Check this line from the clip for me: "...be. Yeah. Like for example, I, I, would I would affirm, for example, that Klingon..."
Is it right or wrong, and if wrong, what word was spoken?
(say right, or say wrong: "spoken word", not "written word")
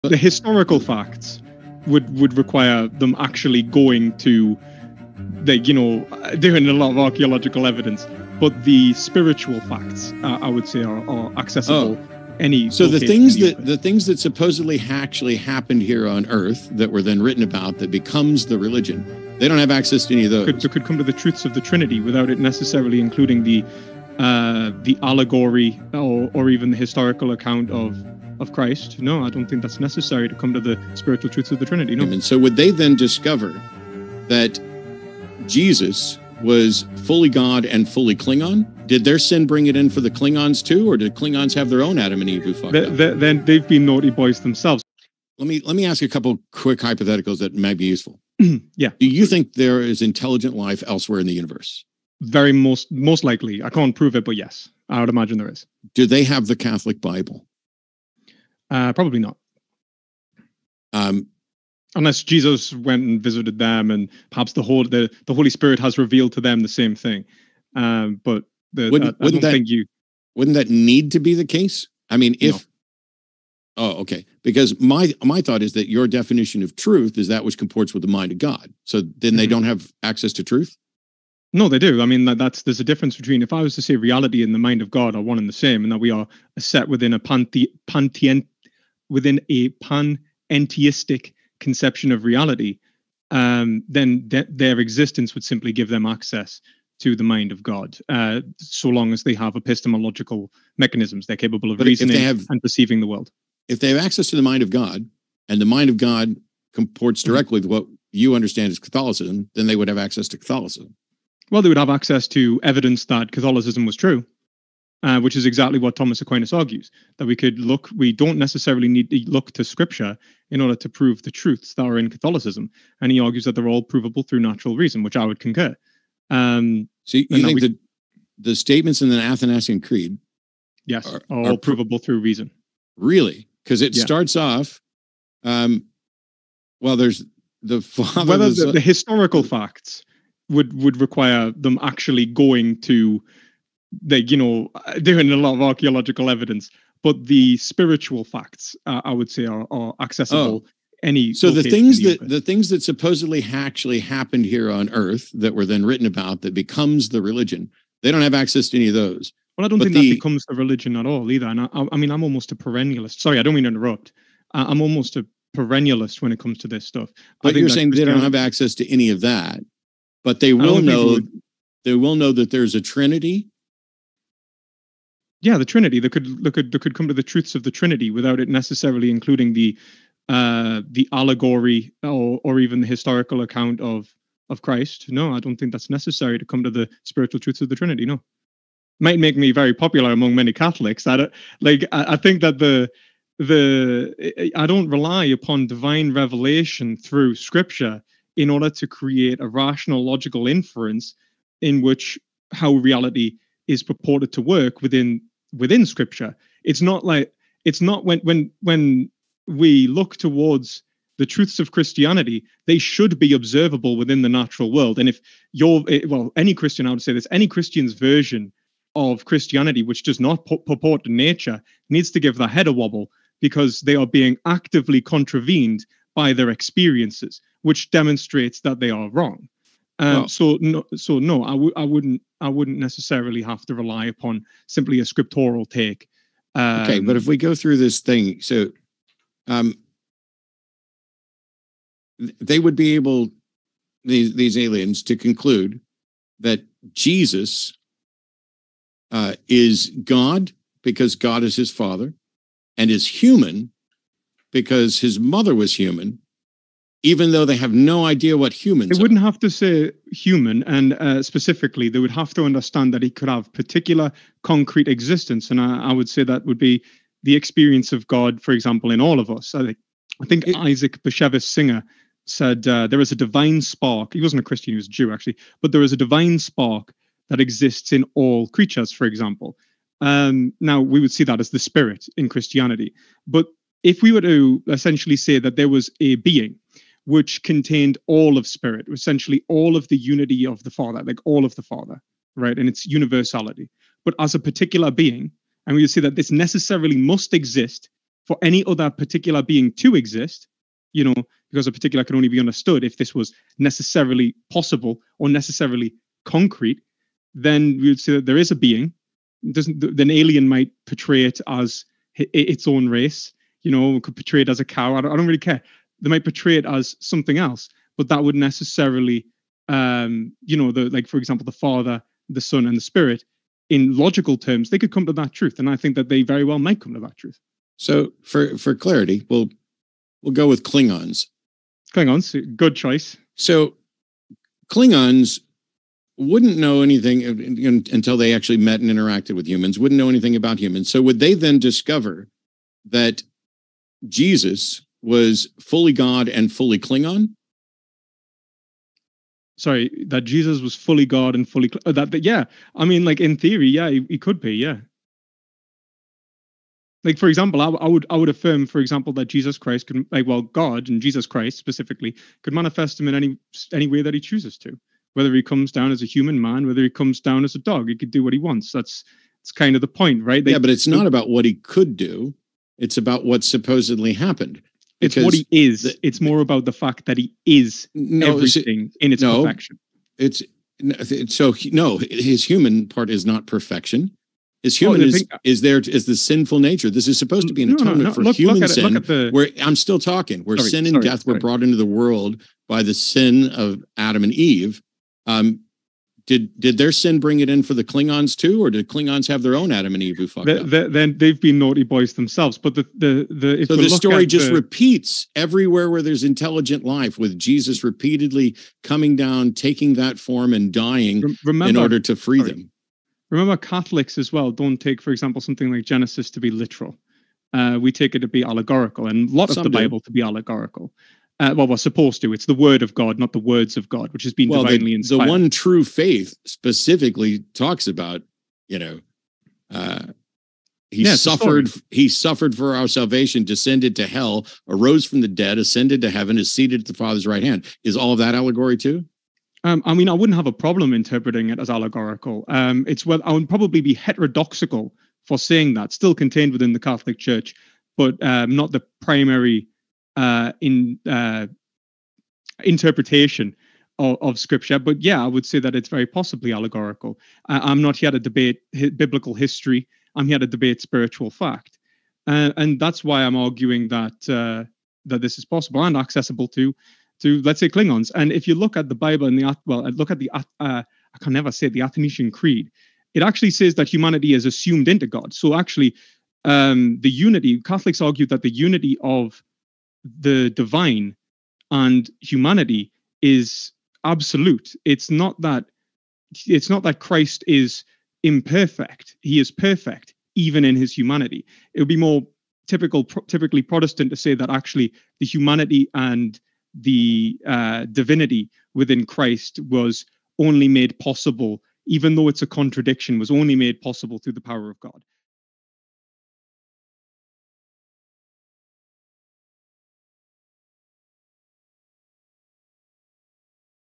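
wrong: "Jesus", not "Klingon".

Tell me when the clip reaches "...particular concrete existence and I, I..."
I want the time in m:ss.
4:23.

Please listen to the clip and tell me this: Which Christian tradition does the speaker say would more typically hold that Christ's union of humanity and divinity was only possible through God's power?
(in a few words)
Protestant.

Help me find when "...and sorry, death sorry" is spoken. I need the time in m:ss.
6:30.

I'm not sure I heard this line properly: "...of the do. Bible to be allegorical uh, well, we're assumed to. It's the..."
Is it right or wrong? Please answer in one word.
wrong.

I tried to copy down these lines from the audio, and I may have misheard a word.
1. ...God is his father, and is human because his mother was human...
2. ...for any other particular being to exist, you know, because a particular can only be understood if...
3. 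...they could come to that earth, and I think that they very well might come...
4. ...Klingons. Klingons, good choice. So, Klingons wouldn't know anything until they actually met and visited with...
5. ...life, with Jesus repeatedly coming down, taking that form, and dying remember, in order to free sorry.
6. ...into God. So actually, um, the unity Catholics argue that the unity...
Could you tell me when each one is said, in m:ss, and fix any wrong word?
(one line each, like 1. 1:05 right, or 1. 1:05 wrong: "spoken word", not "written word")
1. 4:11 right
2. 4:58 right
3. 5:24 wrong: "truth", not "earth"
4. 5:30 wrong: "interacted", not "visited"
5. 6:46 right
6. 7:54 right.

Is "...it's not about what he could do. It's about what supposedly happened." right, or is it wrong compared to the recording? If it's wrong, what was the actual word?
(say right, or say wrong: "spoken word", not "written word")
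right.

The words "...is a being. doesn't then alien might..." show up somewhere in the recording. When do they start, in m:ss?
5:08.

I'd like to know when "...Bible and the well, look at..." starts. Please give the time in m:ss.
7:48.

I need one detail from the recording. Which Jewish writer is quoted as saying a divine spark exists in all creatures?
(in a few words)
Isaac Bashevis Singer.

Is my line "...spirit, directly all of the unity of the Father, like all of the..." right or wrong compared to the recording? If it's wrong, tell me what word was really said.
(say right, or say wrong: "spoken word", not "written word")
wrong: "essentially", not "directly".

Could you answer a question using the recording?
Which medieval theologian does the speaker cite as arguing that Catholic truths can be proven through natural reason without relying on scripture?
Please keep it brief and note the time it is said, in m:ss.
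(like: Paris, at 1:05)
Thomas Aquinas, at 1:55.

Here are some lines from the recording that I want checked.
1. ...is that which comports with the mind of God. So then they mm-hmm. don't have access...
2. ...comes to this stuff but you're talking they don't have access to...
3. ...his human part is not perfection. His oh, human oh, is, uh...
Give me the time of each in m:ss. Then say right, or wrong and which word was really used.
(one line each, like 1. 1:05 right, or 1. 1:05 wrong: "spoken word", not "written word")
1. 1:17 right
2. 2:46 wrong: "saying", not "talking"
3. 6:21 right.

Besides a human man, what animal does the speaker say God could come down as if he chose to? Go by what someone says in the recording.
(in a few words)
a dog.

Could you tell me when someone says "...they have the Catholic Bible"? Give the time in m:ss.
0:56.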